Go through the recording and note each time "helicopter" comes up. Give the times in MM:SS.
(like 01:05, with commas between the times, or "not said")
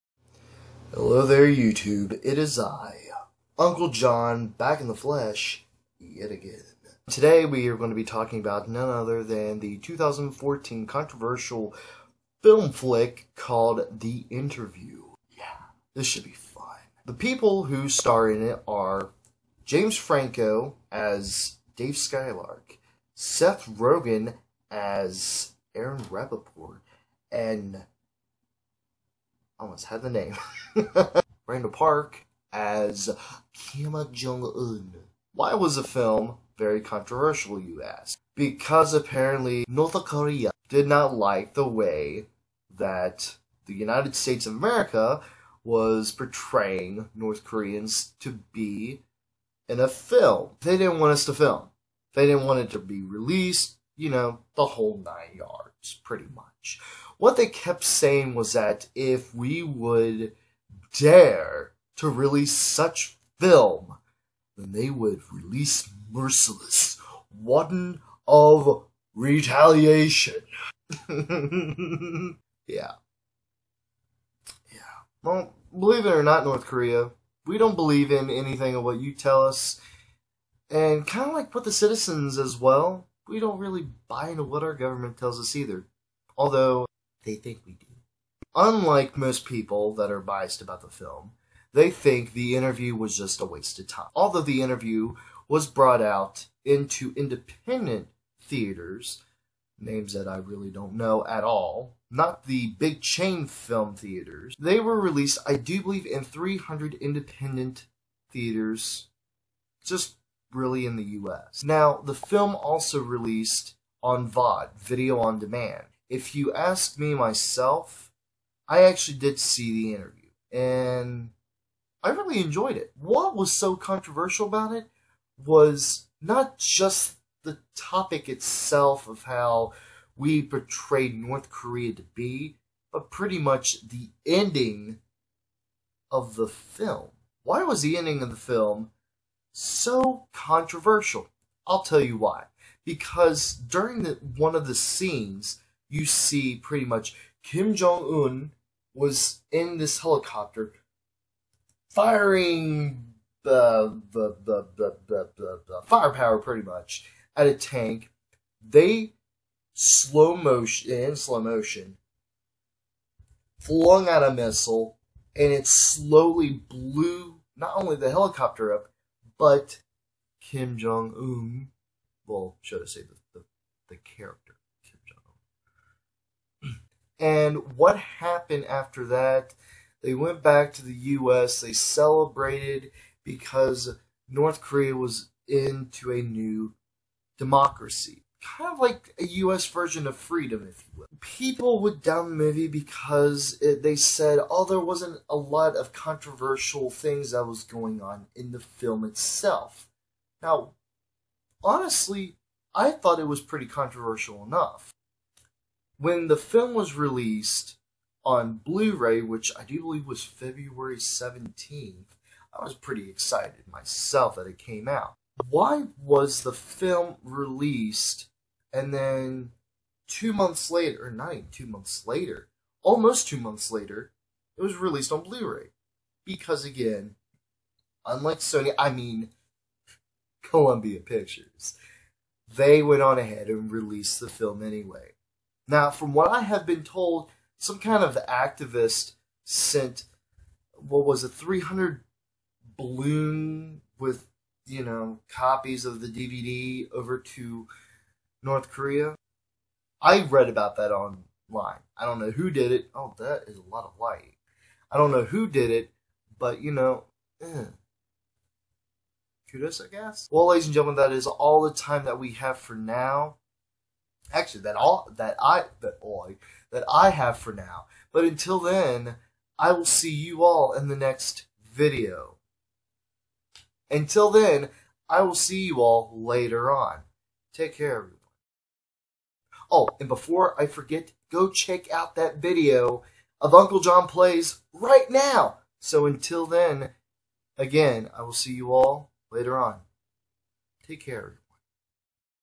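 02:29, 02:48.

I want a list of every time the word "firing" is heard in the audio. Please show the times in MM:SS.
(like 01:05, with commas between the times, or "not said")
02:31.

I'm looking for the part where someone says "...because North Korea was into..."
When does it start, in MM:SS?
03:03.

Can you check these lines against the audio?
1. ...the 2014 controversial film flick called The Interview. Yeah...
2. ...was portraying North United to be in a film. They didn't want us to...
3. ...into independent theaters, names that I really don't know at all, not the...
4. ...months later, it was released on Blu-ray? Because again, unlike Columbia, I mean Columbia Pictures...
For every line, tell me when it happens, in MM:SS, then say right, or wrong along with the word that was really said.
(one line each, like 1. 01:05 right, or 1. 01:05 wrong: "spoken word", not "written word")
1. 00:09 right
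2. 00:45 wrong: "Koreans", not "United"
3. 01:36 right
4. 03:43 wrong: "Sony", not "Columbia".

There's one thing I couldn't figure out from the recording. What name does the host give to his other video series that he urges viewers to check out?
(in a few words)
Uncle Jon Plays.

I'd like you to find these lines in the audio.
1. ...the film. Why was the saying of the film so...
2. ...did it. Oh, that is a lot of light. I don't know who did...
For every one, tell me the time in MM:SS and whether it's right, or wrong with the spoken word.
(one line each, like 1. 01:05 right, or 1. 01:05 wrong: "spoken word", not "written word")
1. 02:16 wrong: "ending", not "saying"
2. 04:12 right.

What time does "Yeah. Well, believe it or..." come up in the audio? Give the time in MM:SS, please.
01:12.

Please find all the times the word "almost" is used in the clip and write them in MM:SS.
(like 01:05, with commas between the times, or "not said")
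00:29, 03:42.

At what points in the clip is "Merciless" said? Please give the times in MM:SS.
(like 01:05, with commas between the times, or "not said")
01:06.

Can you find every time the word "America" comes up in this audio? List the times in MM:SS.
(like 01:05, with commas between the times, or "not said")
00:44.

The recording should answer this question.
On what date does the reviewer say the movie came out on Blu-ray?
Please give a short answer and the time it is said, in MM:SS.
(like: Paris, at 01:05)
February 17th, at 03:30.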